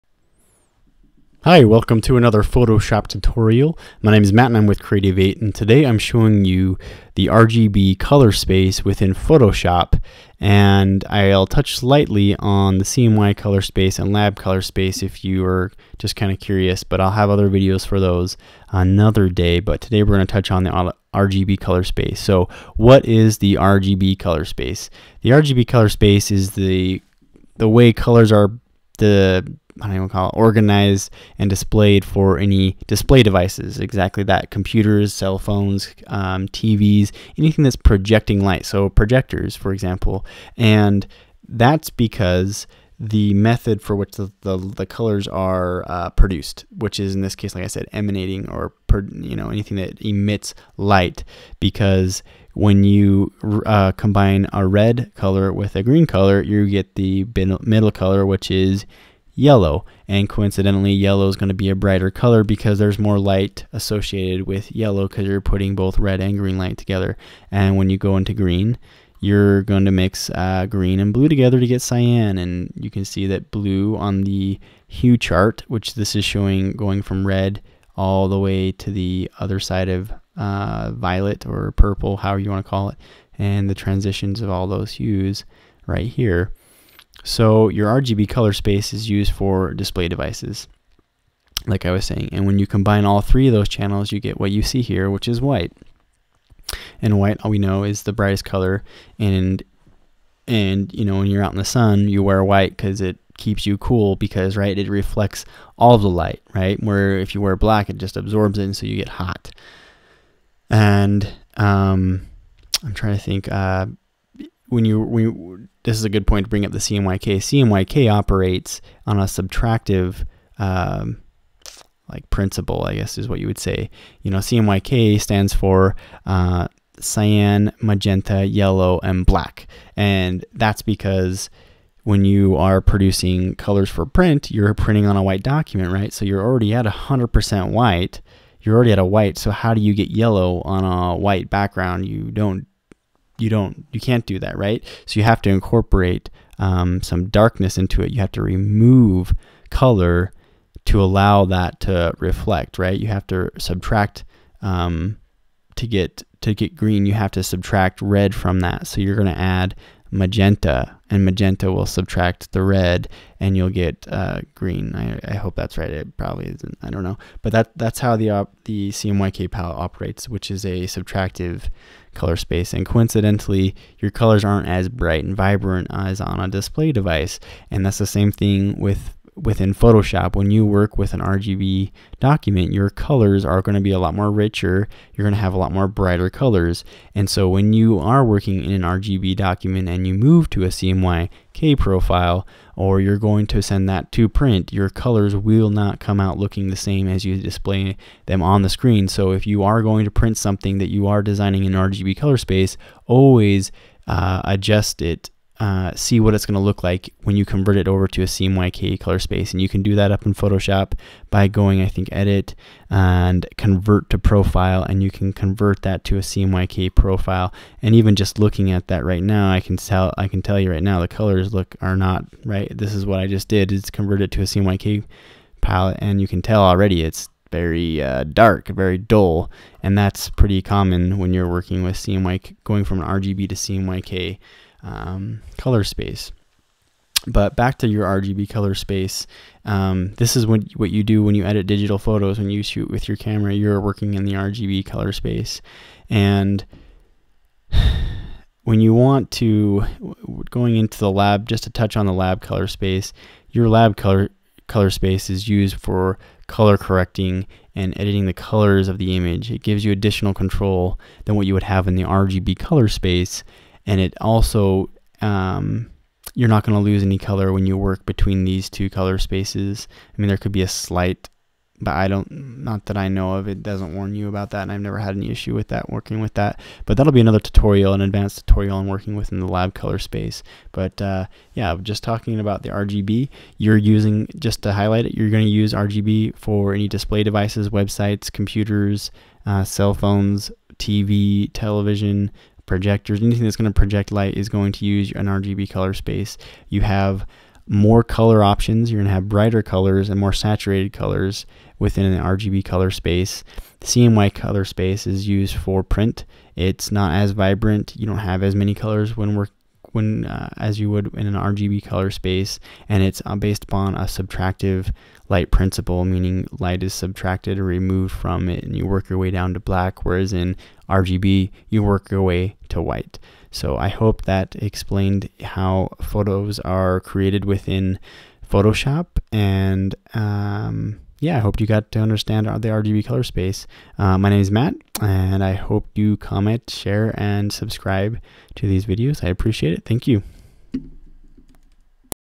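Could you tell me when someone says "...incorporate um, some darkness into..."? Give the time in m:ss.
2:25.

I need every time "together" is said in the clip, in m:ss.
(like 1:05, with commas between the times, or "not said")
1:06, 1:11.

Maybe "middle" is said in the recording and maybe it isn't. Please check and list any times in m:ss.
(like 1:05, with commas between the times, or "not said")
0:57.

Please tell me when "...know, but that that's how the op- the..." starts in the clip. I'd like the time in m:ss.
2:47.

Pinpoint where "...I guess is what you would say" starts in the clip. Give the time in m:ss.
2:02.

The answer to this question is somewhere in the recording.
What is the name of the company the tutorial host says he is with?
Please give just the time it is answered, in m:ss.
0:04.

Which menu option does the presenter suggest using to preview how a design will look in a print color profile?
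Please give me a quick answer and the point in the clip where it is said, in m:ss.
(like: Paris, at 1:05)
Convert to Profile, at 3:33.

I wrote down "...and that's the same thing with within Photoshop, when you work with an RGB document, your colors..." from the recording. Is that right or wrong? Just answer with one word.
right.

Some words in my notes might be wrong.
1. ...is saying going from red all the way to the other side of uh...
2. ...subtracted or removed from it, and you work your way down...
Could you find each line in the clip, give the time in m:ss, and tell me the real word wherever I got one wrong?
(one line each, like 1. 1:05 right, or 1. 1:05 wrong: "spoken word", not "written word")
1. 1:16 wrong: "showing", not "saying"
2. 5:16 right.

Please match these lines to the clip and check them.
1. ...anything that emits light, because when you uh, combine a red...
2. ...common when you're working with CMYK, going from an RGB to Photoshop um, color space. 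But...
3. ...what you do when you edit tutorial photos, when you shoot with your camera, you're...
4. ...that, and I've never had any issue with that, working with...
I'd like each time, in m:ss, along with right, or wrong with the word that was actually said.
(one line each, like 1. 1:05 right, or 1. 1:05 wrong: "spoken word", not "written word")
1. 0:49 right
2. 3:50 wrong: "CMYK", not "Photoshop"
3. 4:00 wrong: "digital", not "tutorial"
4. 4:34 right.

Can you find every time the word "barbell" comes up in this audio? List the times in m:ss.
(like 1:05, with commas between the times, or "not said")
not said.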